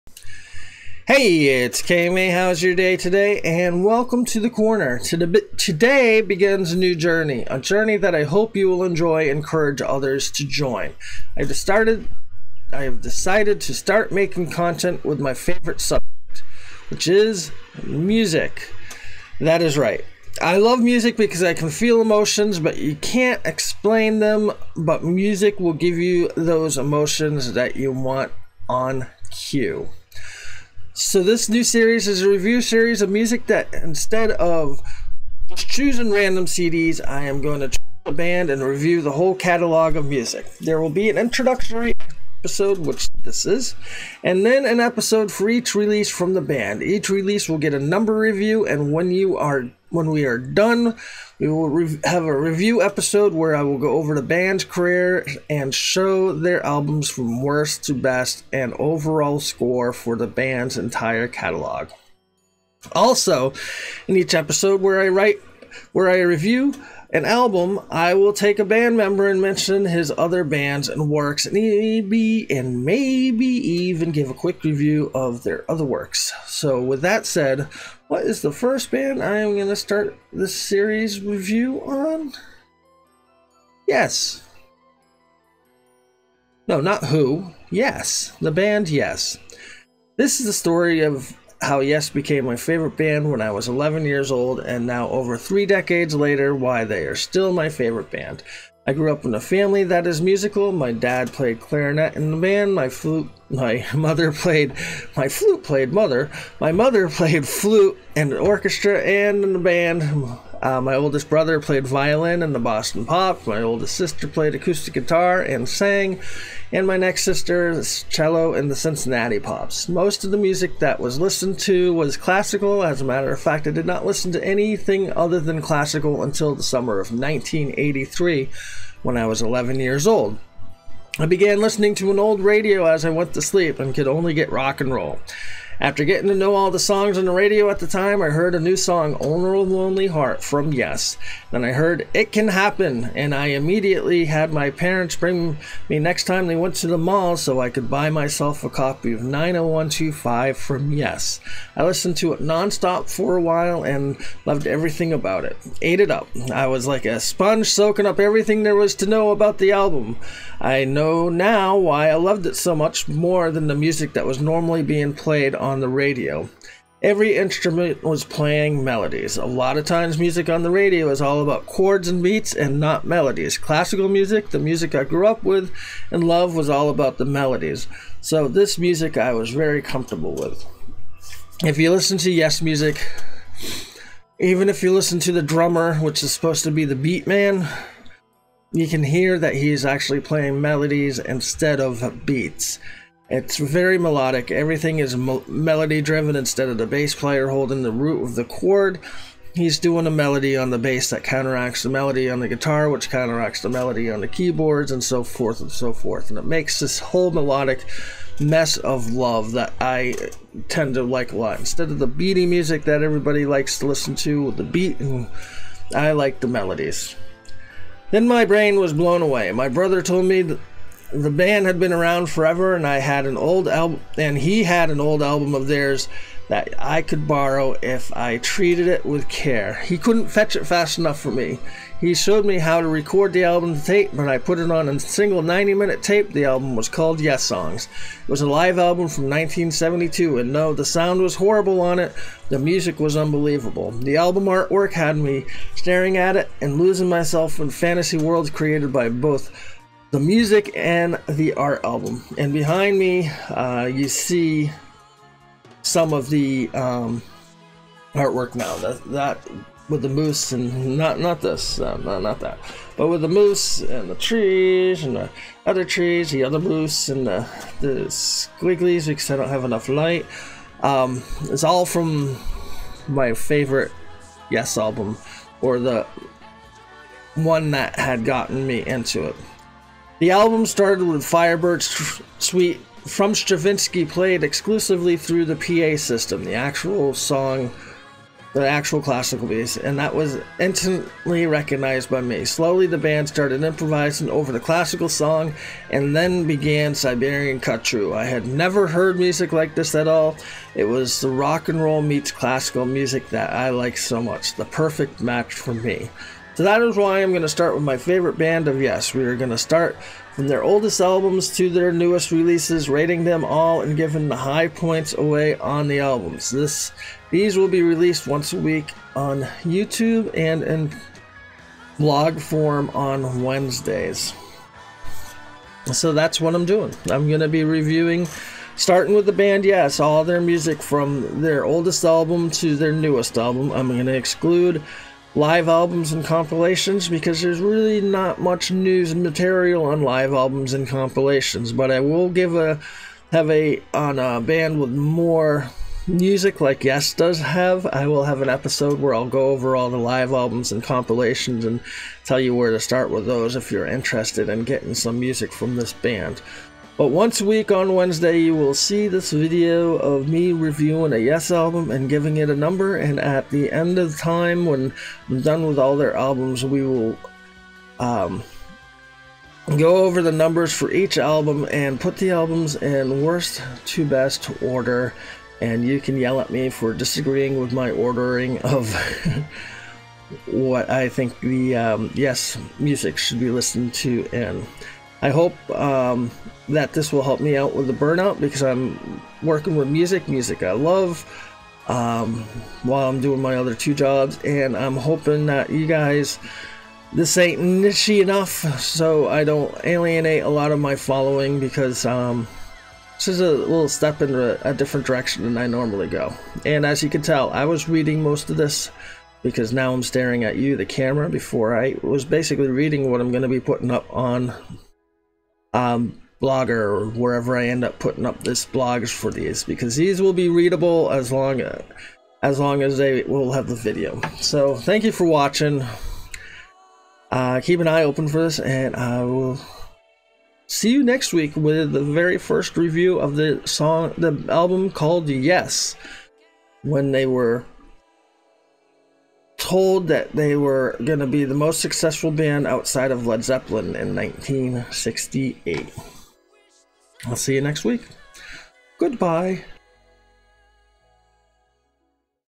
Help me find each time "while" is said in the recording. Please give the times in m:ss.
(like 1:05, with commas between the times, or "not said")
2:33, 6:32.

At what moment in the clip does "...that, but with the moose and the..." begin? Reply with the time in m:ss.
4:22.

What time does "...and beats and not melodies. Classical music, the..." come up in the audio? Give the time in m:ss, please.
2:52.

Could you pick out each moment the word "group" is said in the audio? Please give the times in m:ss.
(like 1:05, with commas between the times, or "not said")
not said.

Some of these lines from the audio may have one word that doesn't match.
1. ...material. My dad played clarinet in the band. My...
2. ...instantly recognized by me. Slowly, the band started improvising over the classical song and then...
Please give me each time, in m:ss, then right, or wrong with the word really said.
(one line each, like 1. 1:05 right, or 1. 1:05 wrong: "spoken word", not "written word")
1. 1:40 wrong: "musical", not "material"
2. 4:50 right.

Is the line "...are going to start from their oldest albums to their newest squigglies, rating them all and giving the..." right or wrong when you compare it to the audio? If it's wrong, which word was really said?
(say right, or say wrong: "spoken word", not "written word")
wrong: "releases", not "squigglies".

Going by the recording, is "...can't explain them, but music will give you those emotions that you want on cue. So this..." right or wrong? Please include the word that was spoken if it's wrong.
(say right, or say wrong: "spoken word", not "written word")
right.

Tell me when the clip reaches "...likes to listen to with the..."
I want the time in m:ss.
3:33.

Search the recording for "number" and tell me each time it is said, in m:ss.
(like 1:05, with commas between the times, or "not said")
0:47, 6:02, 6:10.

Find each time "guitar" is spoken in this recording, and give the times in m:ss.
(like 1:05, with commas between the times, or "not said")
1:54, 3:22.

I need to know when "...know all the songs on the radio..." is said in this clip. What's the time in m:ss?
2:16.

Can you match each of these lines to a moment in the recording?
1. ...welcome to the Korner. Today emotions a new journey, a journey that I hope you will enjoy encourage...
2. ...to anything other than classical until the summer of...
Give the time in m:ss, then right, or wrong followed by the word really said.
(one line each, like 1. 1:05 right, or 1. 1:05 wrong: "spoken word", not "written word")
1. 0:03 wrong: "begins", not "emotions"
2. 2:04 right.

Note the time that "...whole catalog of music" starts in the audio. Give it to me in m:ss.
0:39.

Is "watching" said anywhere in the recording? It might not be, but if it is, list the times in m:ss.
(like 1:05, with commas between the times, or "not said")
7:05.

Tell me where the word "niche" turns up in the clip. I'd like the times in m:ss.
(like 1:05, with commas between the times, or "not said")
6:37.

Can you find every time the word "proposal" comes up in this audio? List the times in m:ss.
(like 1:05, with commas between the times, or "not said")
not said.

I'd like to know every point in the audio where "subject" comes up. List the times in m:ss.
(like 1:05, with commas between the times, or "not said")
0:15.